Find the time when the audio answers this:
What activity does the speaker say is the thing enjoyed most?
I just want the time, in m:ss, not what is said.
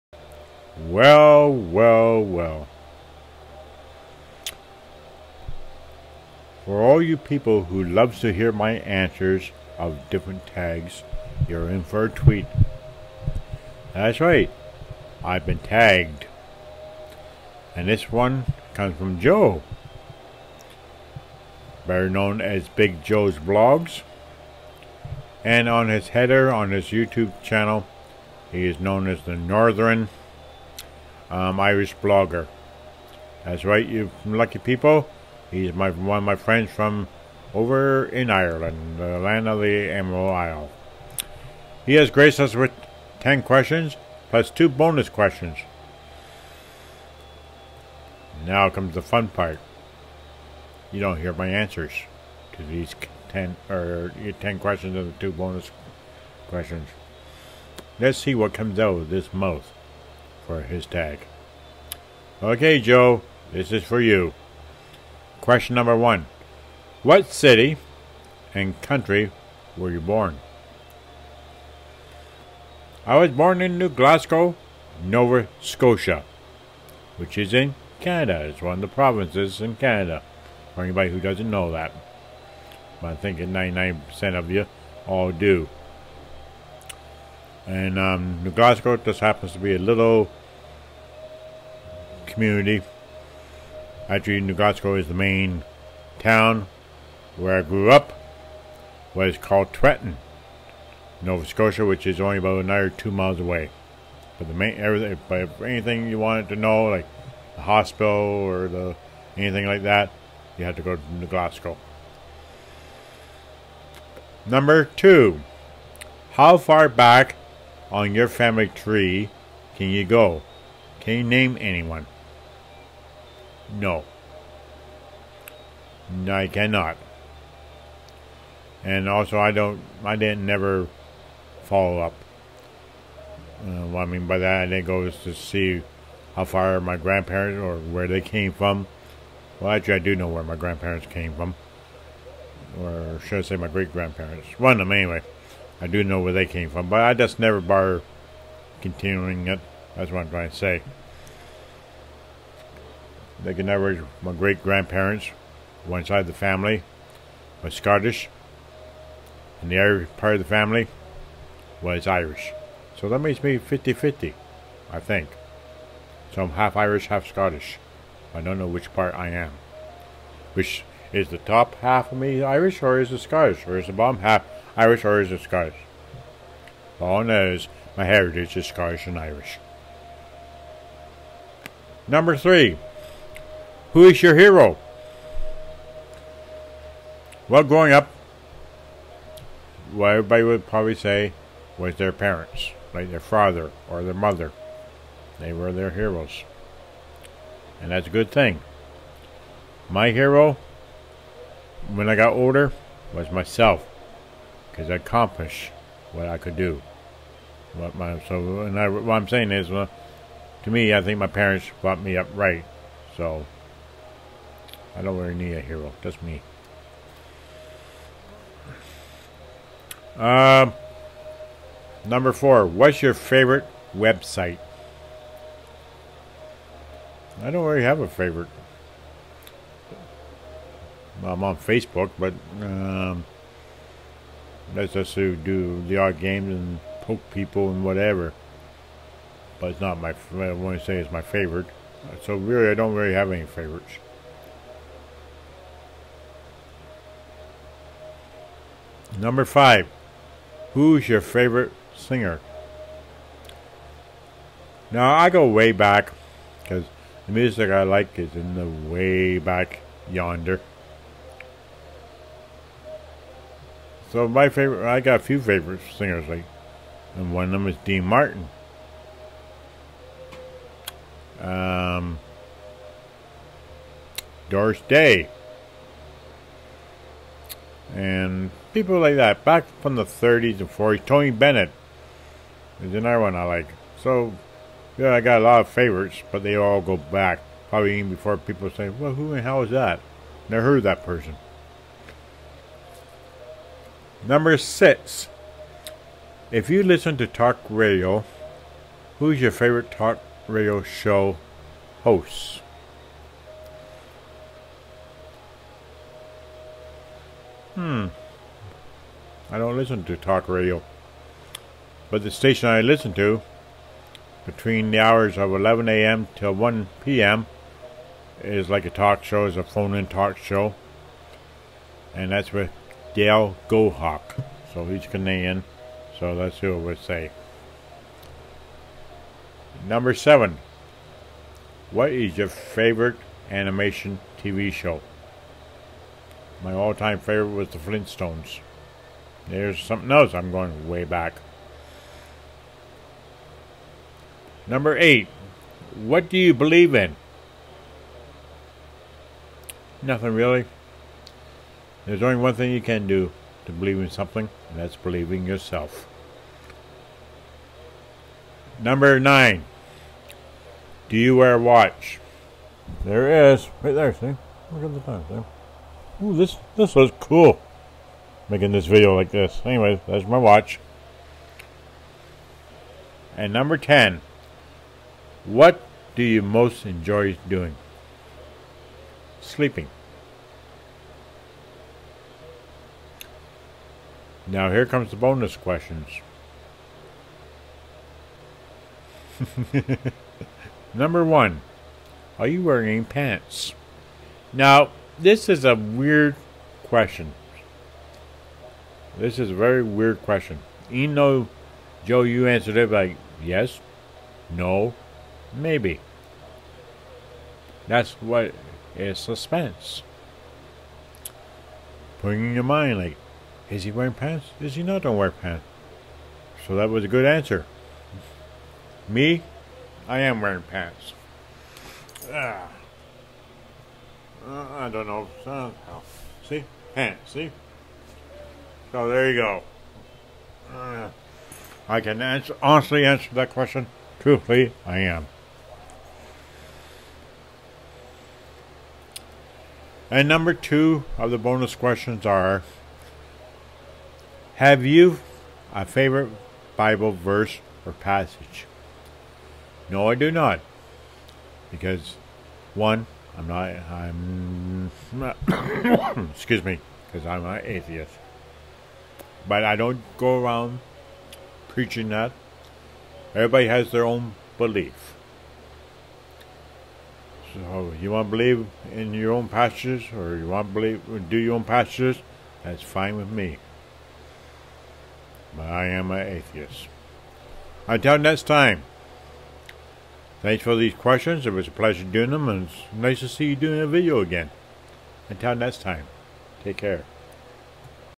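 6:19.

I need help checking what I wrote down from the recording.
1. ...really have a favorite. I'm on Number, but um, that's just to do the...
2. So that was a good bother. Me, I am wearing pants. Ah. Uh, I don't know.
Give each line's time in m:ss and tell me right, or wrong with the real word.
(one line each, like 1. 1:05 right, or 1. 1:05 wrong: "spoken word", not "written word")
1. 3:47 wrong: "Facebook", not "Number"
2. 6:56 wrong: "answer", not "bother".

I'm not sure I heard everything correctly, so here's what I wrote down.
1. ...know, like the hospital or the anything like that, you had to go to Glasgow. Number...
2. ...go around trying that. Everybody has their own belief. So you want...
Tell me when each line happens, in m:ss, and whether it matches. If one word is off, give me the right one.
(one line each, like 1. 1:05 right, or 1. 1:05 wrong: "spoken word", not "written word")
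1. 1:46 right
2. 7:40 wrong: "preaching", not "trying".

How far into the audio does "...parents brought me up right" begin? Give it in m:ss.
3:31.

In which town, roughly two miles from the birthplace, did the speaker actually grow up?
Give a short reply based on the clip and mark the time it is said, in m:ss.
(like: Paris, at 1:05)
Trenton, at 1:39.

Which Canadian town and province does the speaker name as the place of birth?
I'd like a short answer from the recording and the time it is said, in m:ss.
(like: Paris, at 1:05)
New Glasgow, Nova Scotia, at 1:13.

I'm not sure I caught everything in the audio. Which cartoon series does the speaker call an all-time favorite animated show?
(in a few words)
The Flintstones.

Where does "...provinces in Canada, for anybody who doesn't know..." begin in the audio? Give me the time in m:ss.
1:18.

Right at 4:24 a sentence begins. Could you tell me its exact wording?
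So my favorite, I got a few favorite singers, like, and one of them is Dean Martin.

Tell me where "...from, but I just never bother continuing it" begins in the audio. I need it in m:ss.
2:26.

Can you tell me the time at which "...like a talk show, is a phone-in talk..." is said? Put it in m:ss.
5:18.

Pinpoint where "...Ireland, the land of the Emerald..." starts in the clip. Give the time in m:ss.
0:38.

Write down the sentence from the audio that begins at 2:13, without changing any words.
Uh, what I mean by that, I didn't go to see how far my grandparents or where they came from.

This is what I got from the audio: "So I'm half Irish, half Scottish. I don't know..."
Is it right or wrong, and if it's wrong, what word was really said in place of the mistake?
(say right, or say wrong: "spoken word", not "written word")
right.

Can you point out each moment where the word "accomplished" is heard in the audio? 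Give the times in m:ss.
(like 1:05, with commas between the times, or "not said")
3:24.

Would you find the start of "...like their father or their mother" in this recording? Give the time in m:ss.
3:12.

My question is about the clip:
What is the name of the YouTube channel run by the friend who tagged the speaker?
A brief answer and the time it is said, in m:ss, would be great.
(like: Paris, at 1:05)
Big Joe's Vlogs, at 0:22.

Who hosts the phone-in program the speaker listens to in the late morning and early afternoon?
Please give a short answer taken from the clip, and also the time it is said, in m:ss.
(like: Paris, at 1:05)
Dale Gohawk, at 5:23.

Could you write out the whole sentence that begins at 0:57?
Let's see what comes out of this mouth for his tag.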